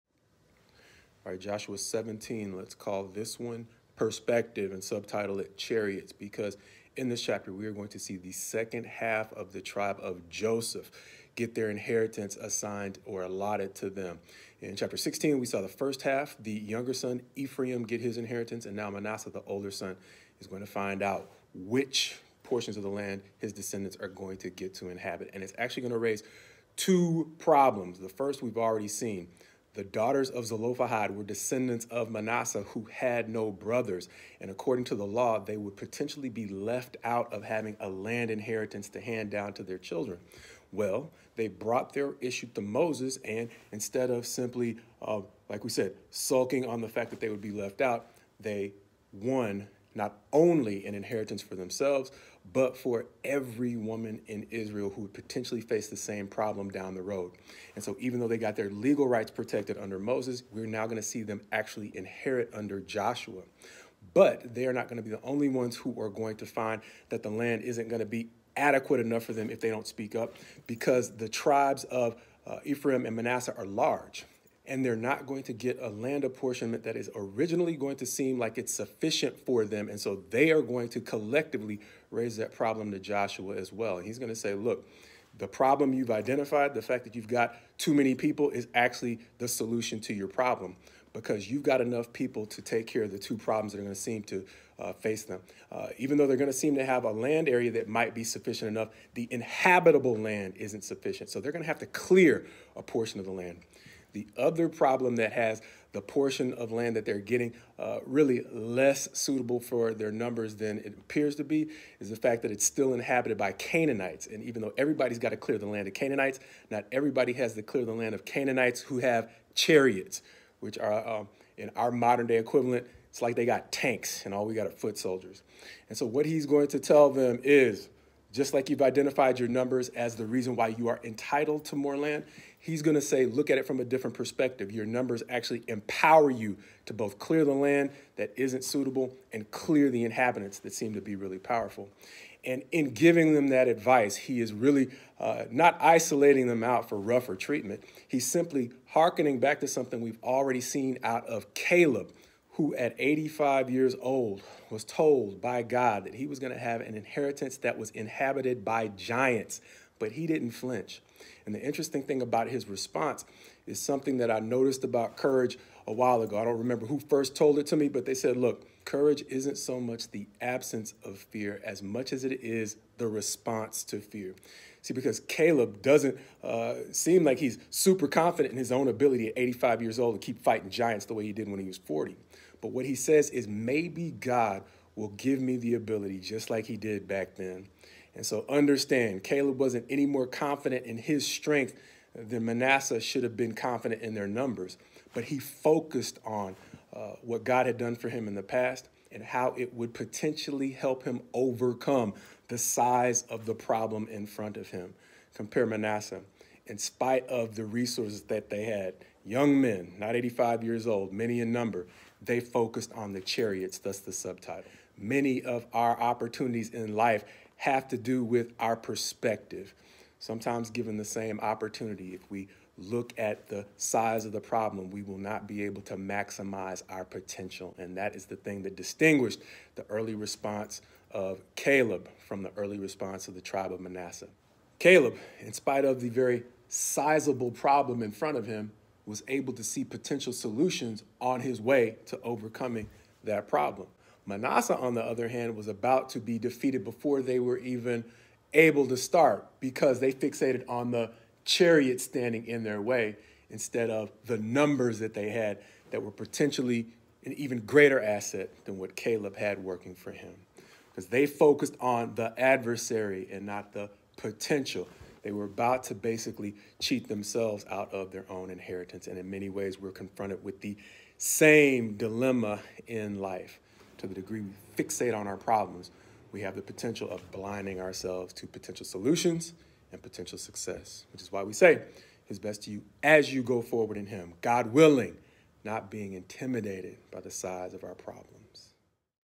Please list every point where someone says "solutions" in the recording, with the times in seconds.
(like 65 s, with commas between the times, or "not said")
89 s, 240 s, 278 s.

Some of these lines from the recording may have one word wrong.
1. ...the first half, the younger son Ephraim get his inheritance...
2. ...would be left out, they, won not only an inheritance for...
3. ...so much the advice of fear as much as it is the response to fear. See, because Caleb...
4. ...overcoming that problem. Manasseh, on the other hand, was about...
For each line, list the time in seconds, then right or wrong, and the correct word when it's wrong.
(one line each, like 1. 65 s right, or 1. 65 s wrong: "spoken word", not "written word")
1. 15 s right
2. 47 s right
3. 169 s wrong: "absence", not "advice"
4. 242 s right.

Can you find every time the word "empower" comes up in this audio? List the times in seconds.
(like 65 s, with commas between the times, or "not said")
135 s.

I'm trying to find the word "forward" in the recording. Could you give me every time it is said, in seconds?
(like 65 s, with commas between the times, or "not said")
283 s.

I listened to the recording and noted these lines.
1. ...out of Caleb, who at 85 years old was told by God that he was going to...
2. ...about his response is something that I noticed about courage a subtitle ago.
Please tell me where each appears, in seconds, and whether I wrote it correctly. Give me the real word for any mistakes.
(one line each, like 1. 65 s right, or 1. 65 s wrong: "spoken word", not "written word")
1. 151 s right
2. 162 s wrong: "while", not "subtitle".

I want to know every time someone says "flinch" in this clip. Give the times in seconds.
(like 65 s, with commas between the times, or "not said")
160 s.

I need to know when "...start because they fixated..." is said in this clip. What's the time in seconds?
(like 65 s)
248 s.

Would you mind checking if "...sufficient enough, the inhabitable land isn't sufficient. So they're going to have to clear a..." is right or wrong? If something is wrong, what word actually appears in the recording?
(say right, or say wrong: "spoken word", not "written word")
right.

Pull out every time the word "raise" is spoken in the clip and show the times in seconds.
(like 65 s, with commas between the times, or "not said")
25 s, 82 s.